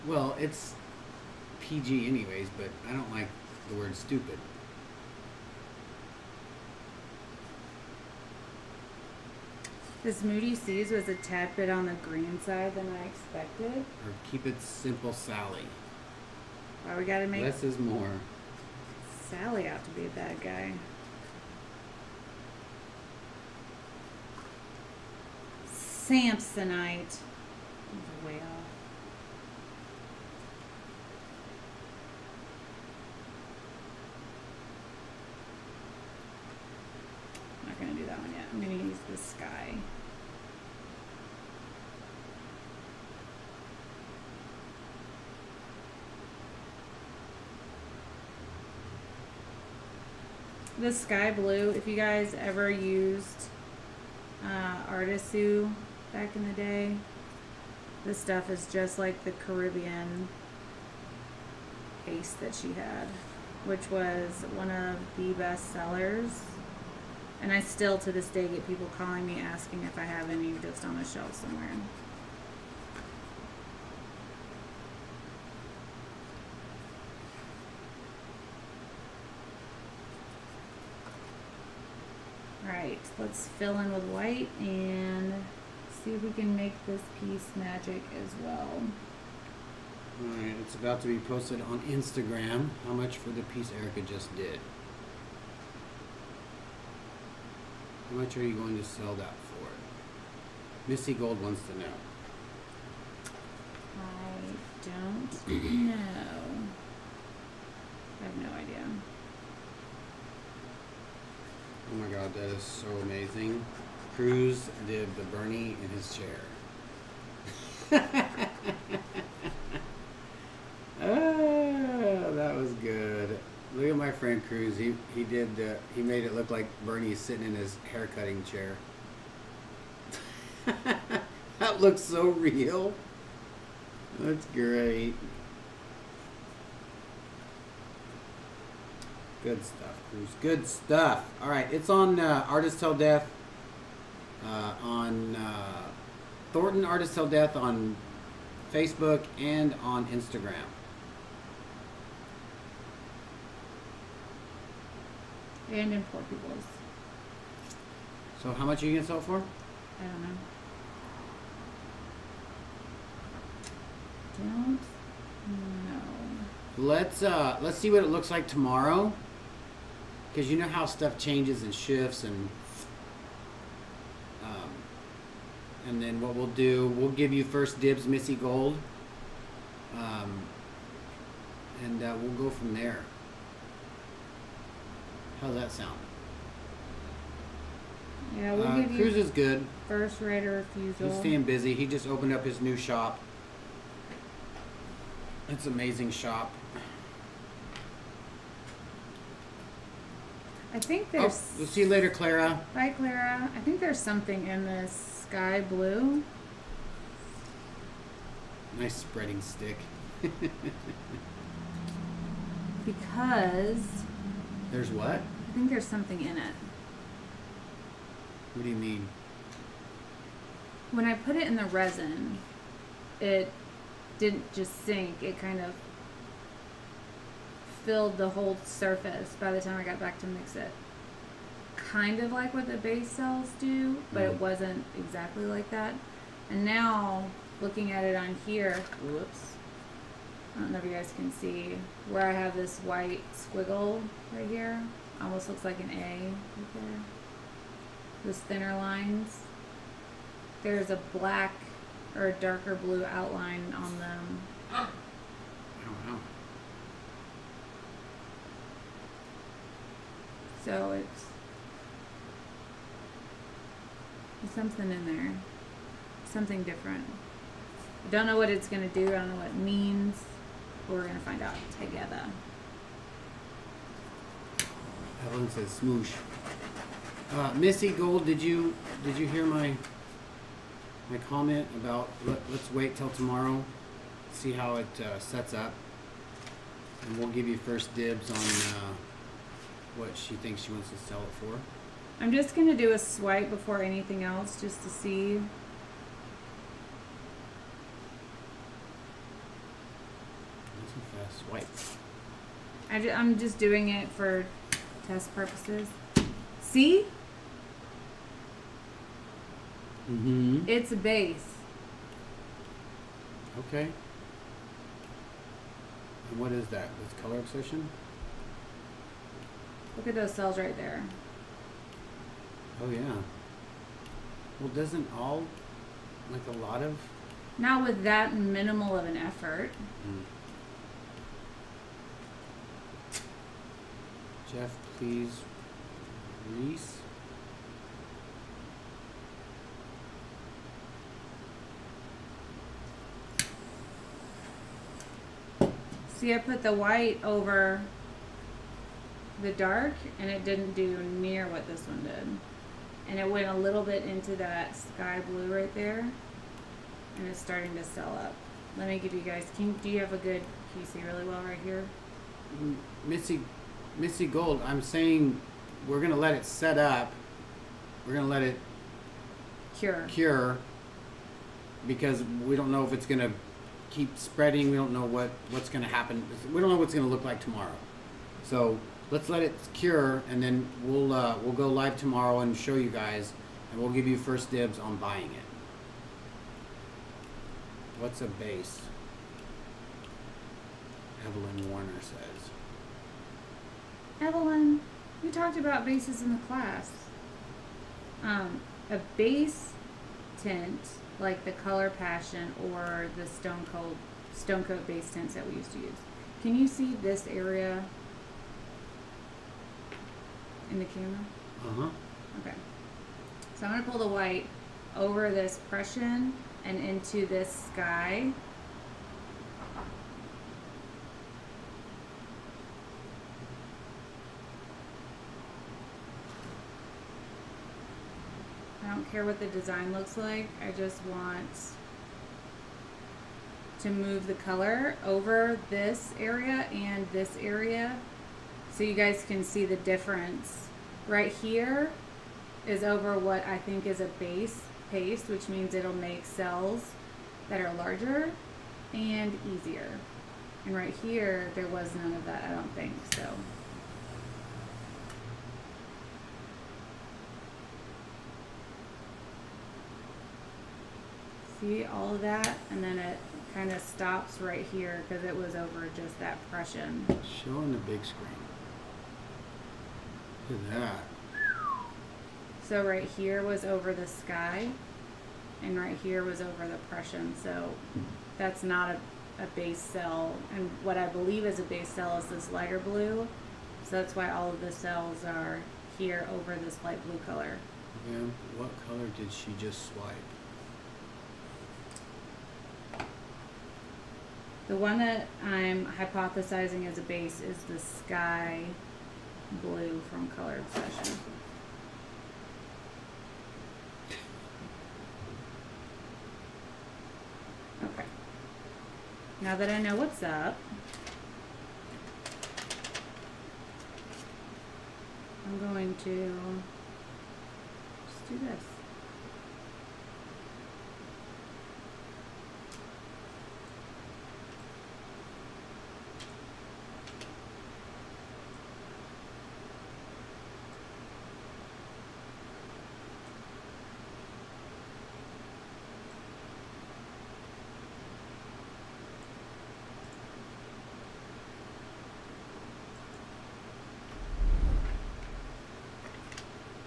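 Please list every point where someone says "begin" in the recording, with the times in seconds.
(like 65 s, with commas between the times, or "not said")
not said.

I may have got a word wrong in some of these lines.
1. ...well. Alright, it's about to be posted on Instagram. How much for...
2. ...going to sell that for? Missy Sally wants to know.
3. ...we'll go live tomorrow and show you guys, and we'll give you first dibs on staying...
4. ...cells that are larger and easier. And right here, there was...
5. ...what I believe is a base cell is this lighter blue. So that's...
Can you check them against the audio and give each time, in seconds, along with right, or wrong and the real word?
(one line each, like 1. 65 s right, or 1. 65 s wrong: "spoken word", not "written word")
1. 88 s right
2. 98 s wrong: "Gold", not "Sally"
3. 381 s wrong: "buying", not "staying"
4. 446 s right
5. 480 s right.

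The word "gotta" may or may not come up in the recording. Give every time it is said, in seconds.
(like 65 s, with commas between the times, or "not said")
17 s.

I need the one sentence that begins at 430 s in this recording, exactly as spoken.
I just want to move the color over this area and this area so you guys can see the difference.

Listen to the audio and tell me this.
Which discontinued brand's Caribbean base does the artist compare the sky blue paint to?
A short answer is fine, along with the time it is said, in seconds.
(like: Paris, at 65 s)
Artisu, at 54 s.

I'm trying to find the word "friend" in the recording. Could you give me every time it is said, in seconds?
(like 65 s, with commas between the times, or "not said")
124 s.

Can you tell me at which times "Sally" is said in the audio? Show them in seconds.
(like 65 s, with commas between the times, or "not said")
15 s, 19 s.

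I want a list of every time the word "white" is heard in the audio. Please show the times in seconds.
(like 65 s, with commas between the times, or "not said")
84 s, 242 s, 346 s, 414 s.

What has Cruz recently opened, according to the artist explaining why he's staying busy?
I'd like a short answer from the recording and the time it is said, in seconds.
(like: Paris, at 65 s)
new shop, at 192 s.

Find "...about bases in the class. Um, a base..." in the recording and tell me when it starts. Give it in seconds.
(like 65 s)
395 s.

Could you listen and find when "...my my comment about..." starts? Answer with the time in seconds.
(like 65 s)
279 s.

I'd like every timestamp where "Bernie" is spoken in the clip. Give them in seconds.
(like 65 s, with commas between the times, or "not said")
115 s, 126 s.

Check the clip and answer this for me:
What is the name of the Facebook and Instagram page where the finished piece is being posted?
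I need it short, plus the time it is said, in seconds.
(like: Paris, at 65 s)
Thornton Artist Till Death, at 146 s.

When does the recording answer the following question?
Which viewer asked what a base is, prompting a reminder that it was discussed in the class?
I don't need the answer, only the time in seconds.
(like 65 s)
391 s.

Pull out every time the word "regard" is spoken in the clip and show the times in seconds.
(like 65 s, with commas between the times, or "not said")
not said.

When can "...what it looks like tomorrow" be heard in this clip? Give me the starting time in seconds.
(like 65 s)
167 s.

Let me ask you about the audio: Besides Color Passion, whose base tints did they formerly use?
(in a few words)
Stone Coat.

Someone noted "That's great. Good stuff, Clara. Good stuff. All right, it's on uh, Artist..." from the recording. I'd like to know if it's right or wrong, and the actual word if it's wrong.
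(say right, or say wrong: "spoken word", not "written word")
wrong: "Cruz", not "Clara".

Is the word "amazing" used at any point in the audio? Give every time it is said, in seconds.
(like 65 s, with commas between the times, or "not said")
113 s, 195 s.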